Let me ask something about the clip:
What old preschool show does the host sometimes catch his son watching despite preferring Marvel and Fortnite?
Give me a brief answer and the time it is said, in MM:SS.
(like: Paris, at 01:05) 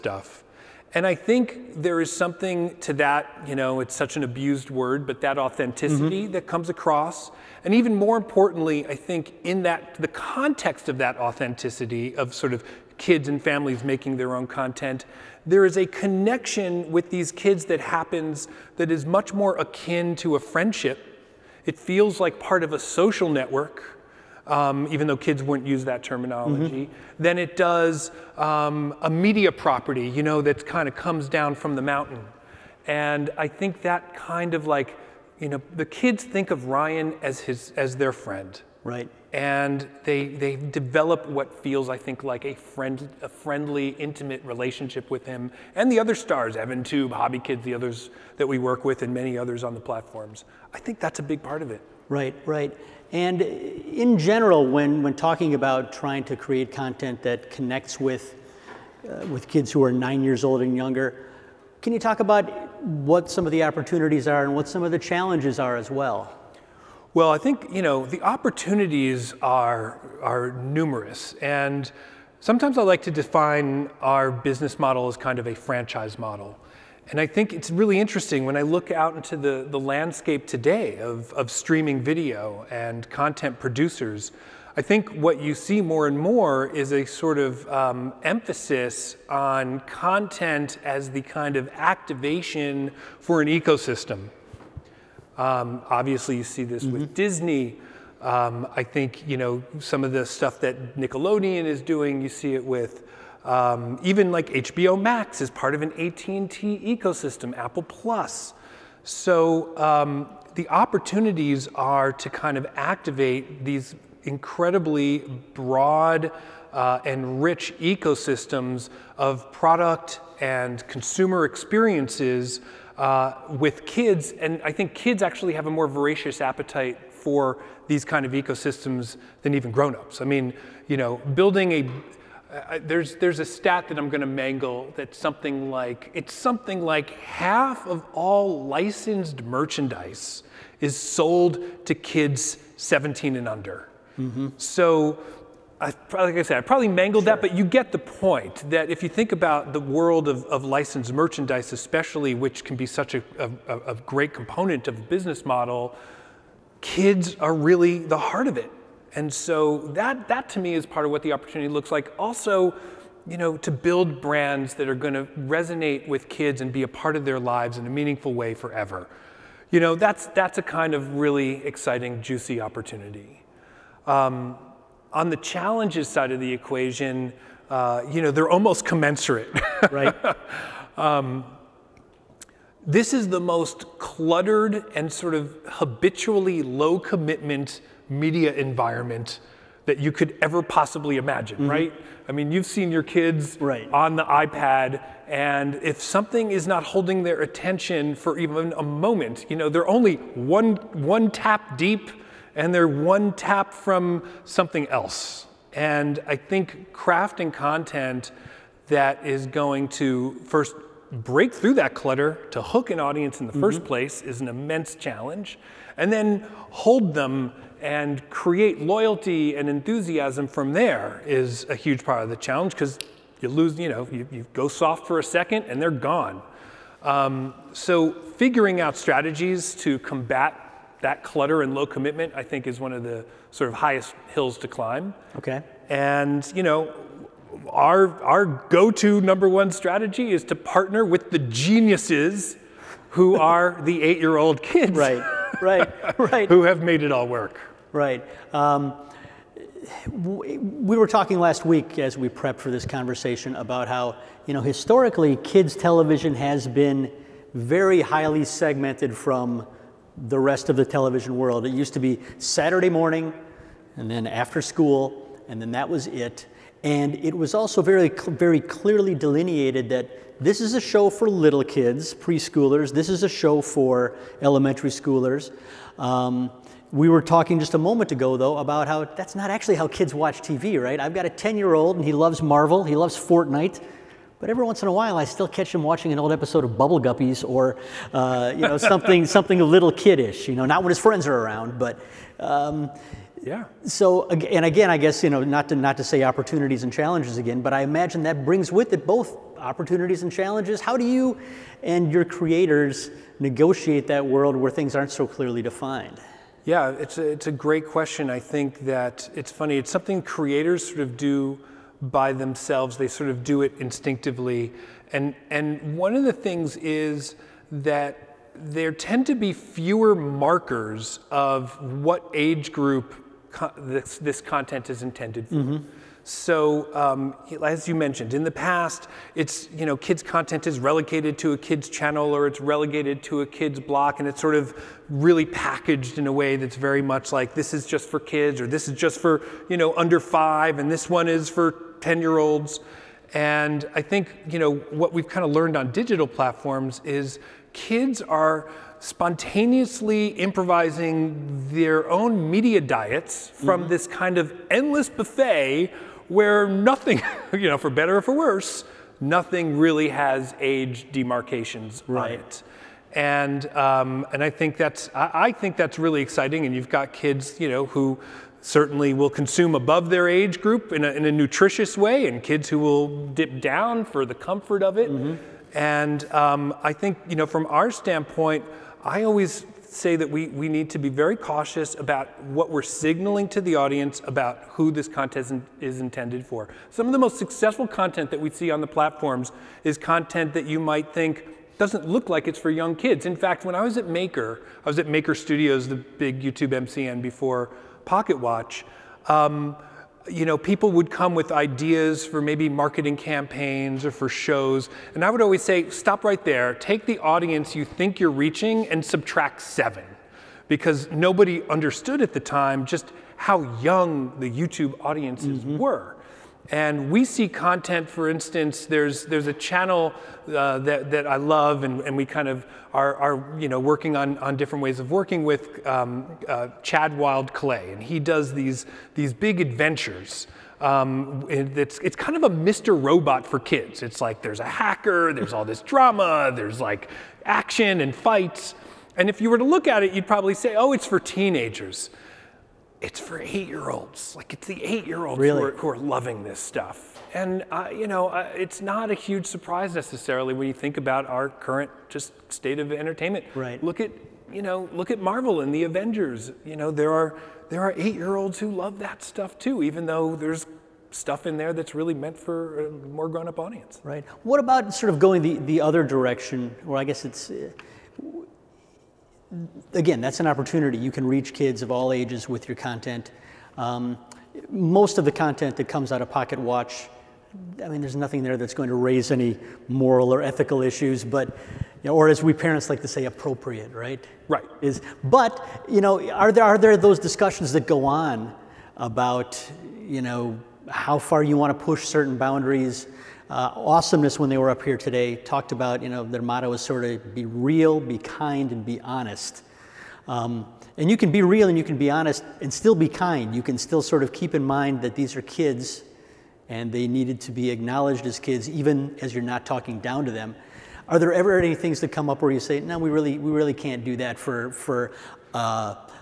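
Bubble Guppies, at 04:46.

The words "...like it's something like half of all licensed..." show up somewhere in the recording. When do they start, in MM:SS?
02:15.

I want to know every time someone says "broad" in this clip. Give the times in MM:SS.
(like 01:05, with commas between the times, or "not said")
01:55.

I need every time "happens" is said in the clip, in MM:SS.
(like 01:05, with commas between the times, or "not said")
00:17.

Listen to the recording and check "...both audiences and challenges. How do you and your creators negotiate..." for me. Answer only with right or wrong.
wrong.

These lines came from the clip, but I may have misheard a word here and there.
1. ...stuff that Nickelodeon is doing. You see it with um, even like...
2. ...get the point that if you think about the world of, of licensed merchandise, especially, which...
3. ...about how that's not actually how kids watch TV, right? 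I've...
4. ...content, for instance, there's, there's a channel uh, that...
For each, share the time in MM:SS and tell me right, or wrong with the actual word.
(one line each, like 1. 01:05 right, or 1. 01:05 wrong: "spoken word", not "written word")
1. 01:40 right
2. 02:27 right
3. 04:38 right
4. 06:57 right.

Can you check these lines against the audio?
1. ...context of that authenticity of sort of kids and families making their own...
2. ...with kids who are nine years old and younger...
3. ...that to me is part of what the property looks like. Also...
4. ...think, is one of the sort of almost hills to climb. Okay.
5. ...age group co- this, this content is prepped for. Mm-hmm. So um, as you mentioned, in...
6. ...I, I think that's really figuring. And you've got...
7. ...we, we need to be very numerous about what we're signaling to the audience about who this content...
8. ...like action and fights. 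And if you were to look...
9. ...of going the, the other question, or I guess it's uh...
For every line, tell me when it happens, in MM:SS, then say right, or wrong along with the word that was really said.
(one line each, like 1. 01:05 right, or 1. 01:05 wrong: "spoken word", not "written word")
1. 00:10 right
2. 00:59 right
3. 02:40 wrong: "opportunity", not "property"
4. 03:52 wrong: "highest", not "almost"
5. 05:22 wrong: "intended", not "prepped"
6. 06:05 wrong: "exciting", not "figuring"
7. 06:20 wrong: "cautious", not "numerous"
8. 07:16 right
9. 07:45 wrong: "direction", not "question".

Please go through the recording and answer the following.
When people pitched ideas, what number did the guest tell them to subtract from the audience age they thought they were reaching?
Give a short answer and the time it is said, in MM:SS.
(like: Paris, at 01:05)
7, at 06:49.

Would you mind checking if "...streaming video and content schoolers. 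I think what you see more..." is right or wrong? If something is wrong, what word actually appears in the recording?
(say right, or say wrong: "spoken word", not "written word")
wrong: "producers", not "schoolers".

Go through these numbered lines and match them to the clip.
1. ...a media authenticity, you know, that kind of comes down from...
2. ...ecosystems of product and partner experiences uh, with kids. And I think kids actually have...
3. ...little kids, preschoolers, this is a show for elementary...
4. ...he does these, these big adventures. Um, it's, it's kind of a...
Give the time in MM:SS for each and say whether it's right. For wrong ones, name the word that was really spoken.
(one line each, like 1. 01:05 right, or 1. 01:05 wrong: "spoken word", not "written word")
1. 00:29 wrong: "property", not "authenticity"
2. 01:57 wrong: "consumer", not "partner"
3. 04:31 right
4. 07:08 right.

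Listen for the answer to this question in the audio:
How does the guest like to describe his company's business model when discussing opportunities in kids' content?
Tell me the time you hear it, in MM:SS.
01:15.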